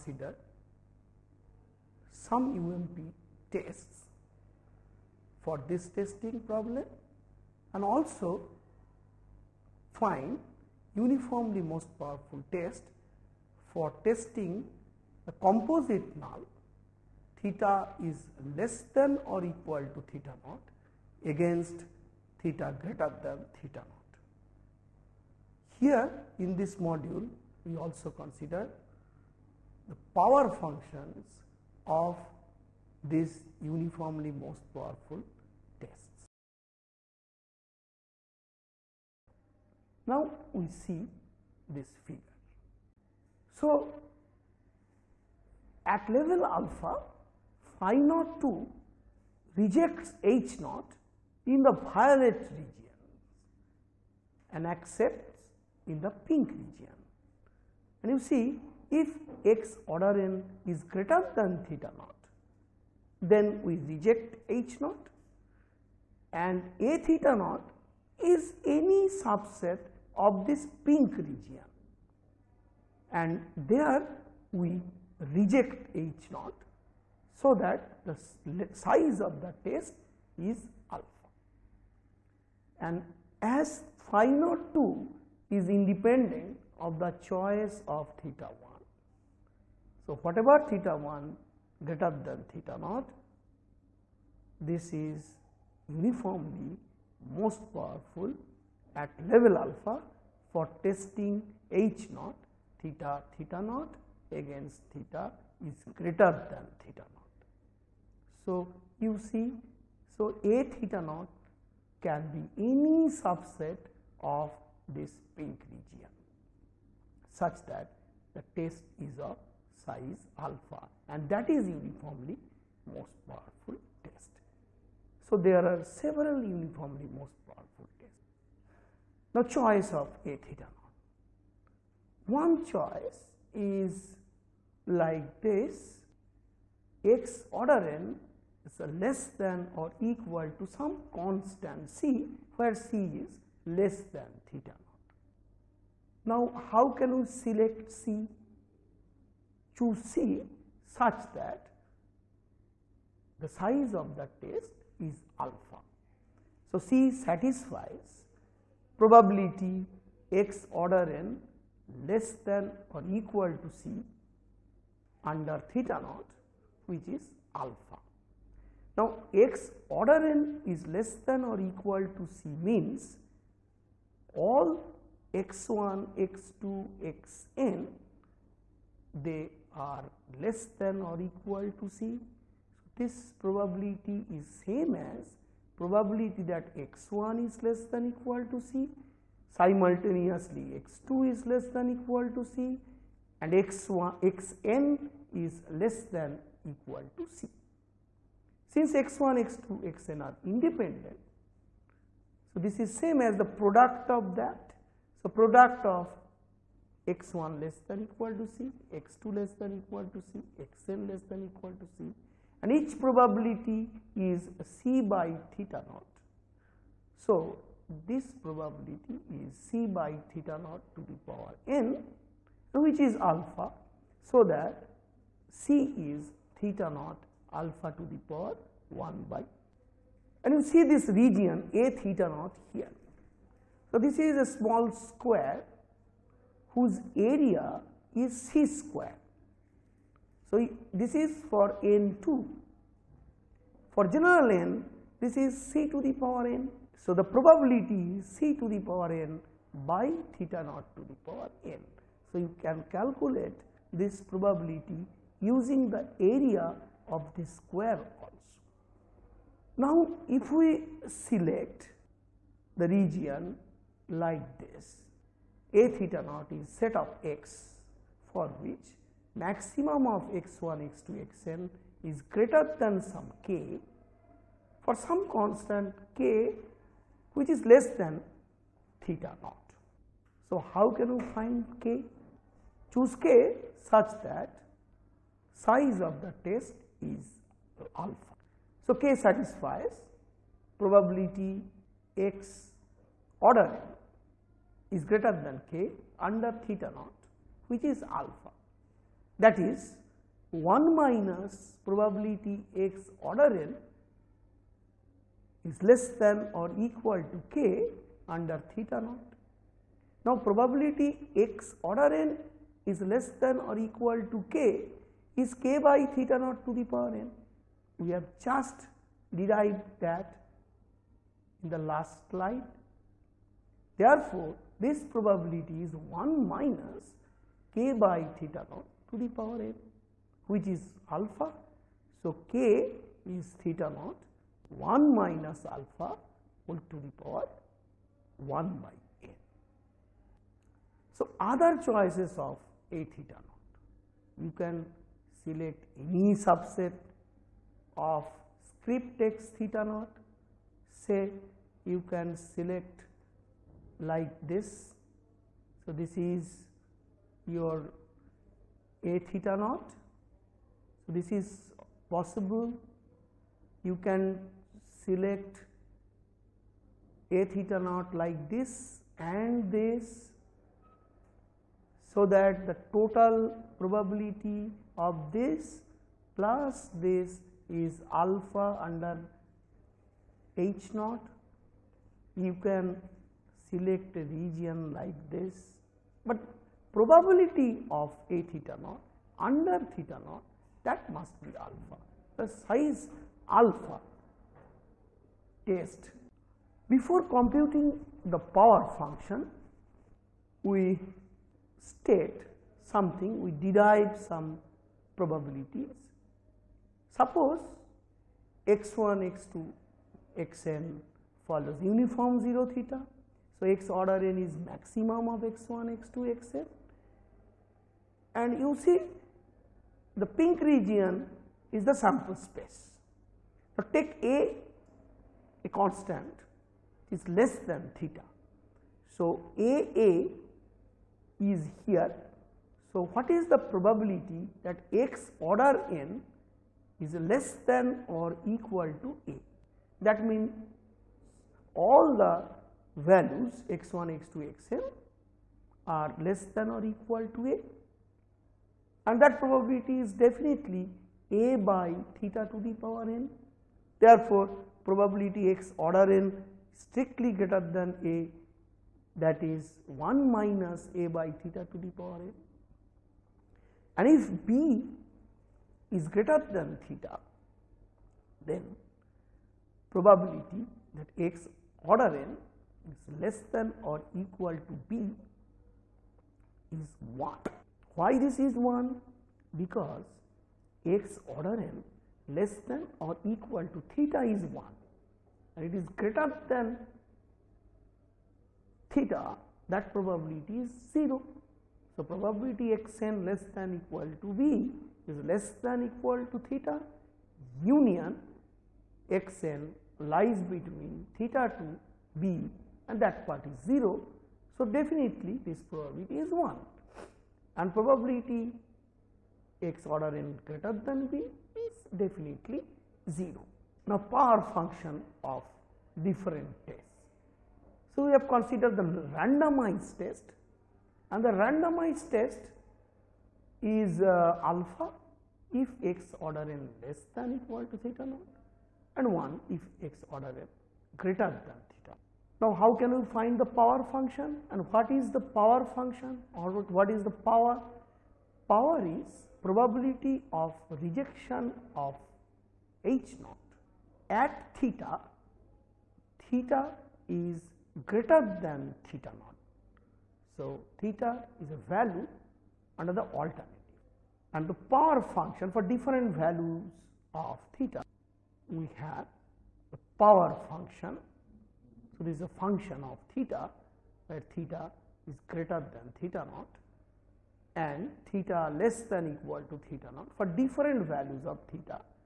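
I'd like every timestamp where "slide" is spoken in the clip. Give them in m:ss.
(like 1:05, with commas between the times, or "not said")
5:22.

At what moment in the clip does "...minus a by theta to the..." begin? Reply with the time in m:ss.
7:40.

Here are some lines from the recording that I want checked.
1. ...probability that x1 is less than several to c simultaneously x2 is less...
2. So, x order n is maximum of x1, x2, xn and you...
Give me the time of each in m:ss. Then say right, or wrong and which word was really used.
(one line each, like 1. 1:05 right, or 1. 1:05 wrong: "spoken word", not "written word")
1. 3:05 wrong: "equal", not "several"
2. 6:53 right.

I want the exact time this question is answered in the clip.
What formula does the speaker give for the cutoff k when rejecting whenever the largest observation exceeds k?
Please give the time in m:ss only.
5:33.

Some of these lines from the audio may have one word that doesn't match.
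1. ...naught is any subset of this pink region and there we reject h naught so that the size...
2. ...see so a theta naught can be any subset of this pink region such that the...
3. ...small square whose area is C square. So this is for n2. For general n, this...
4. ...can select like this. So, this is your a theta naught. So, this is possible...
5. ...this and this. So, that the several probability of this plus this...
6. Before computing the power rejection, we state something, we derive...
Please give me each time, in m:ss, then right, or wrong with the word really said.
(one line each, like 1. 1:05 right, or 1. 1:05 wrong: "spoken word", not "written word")
1. 1:07 right
2. 1:49 right
3. 3:54 right
4. 5:52 right
5. 6:08 wrong: "total", not "several"
6. 6:36 wrong: "function", not "rejection".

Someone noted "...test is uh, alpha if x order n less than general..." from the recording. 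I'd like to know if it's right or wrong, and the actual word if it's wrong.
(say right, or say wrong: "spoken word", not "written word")
wrong: "equal", not "general".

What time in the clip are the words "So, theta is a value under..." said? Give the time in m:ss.
9:10.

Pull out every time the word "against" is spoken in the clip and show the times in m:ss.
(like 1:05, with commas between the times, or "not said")
0:21, 1:44.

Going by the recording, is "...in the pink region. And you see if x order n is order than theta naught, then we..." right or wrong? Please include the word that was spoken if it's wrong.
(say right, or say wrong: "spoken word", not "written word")
wrong: "greater", not "order".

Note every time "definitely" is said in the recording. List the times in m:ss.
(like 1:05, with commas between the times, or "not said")
7:30, 8:24, 8:32.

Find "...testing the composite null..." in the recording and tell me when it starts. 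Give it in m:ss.
0:14.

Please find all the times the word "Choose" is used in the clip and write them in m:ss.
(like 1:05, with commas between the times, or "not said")
2:29, 4:42.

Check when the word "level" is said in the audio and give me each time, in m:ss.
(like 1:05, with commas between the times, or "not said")
0:46, 1:39.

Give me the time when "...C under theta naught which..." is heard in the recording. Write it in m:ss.
2:43.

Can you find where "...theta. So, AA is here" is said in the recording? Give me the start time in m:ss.
7:07.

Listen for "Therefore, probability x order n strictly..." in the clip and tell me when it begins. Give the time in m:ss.
7:33.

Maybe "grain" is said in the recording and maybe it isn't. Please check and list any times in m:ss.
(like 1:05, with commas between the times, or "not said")
not said.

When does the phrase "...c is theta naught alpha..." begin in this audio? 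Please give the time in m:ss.
3:45.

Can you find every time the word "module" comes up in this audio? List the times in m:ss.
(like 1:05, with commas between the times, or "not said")
0:26.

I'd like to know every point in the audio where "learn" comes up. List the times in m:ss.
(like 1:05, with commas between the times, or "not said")
not said.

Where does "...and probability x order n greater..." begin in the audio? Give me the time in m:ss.
8:27.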